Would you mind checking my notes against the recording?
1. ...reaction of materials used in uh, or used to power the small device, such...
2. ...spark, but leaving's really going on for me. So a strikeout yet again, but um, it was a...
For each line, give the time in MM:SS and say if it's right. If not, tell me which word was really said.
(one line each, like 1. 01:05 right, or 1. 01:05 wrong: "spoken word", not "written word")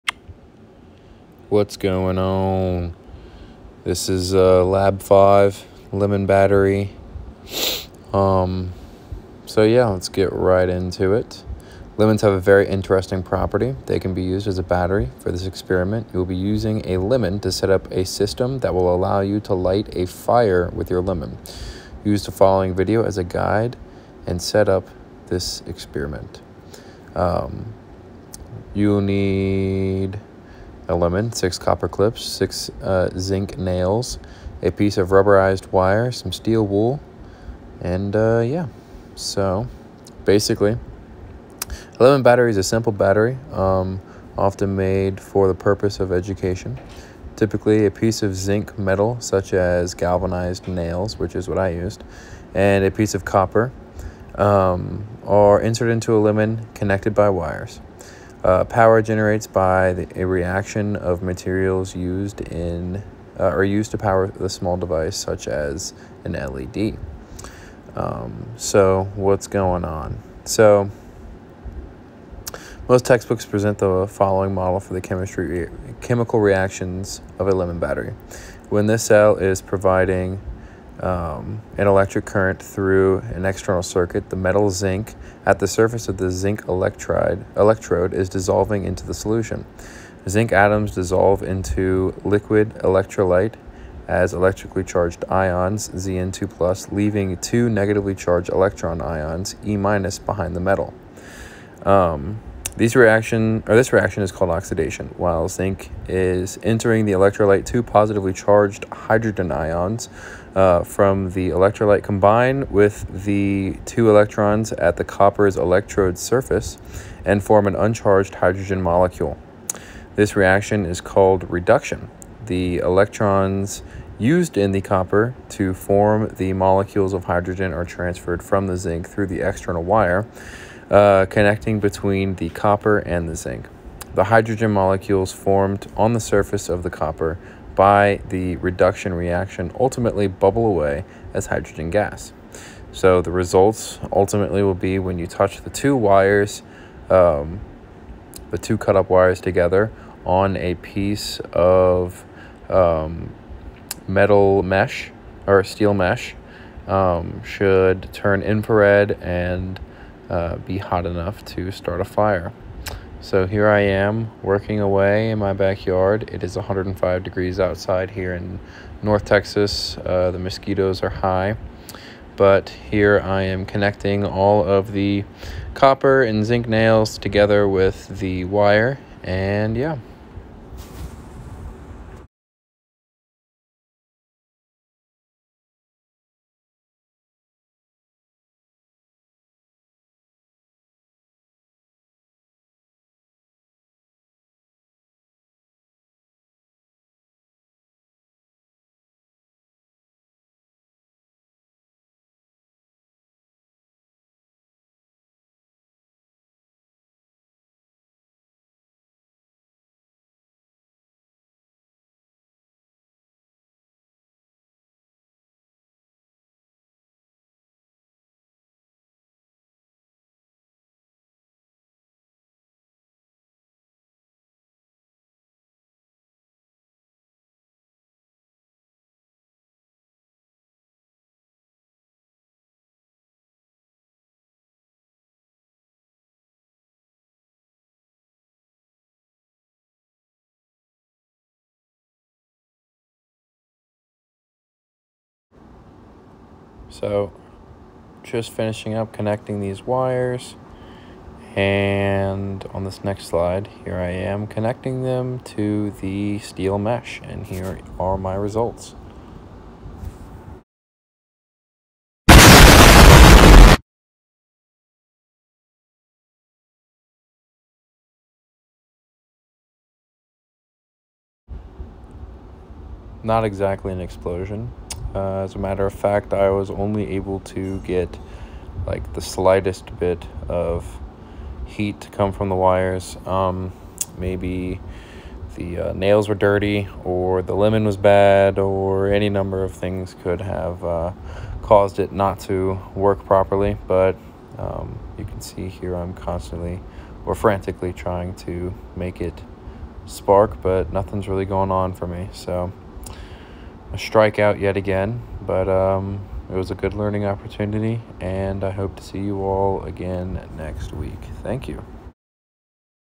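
1. 01:00 right
2. 05:00 wrong: "nothing", not "leaving".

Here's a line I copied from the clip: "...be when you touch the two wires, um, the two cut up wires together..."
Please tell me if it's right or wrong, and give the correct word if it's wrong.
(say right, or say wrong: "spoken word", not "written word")
right.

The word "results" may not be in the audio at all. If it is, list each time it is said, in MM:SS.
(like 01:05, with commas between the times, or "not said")
02:23, 04:18.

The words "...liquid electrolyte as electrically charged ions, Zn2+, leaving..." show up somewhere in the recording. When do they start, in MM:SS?
01:32.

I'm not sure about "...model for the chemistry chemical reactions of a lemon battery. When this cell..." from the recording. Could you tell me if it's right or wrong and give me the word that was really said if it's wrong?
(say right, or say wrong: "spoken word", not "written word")
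right.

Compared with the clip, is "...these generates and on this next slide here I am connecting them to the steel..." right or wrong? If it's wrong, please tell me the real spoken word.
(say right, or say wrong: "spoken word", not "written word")
wrong: "wires", not "generates".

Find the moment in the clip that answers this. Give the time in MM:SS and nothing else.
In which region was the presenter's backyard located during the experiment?
02:49.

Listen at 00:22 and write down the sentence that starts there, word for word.
Use the following video as a guide and set up this experiment.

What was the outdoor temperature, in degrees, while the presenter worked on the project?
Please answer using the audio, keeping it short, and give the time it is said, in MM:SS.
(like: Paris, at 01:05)
105, at 02:46.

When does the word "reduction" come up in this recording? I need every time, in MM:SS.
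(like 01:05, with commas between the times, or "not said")
02:01, 02:18.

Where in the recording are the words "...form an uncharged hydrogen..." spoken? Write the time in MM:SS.
01:57.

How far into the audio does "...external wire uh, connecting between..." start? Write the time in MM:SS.
02:09.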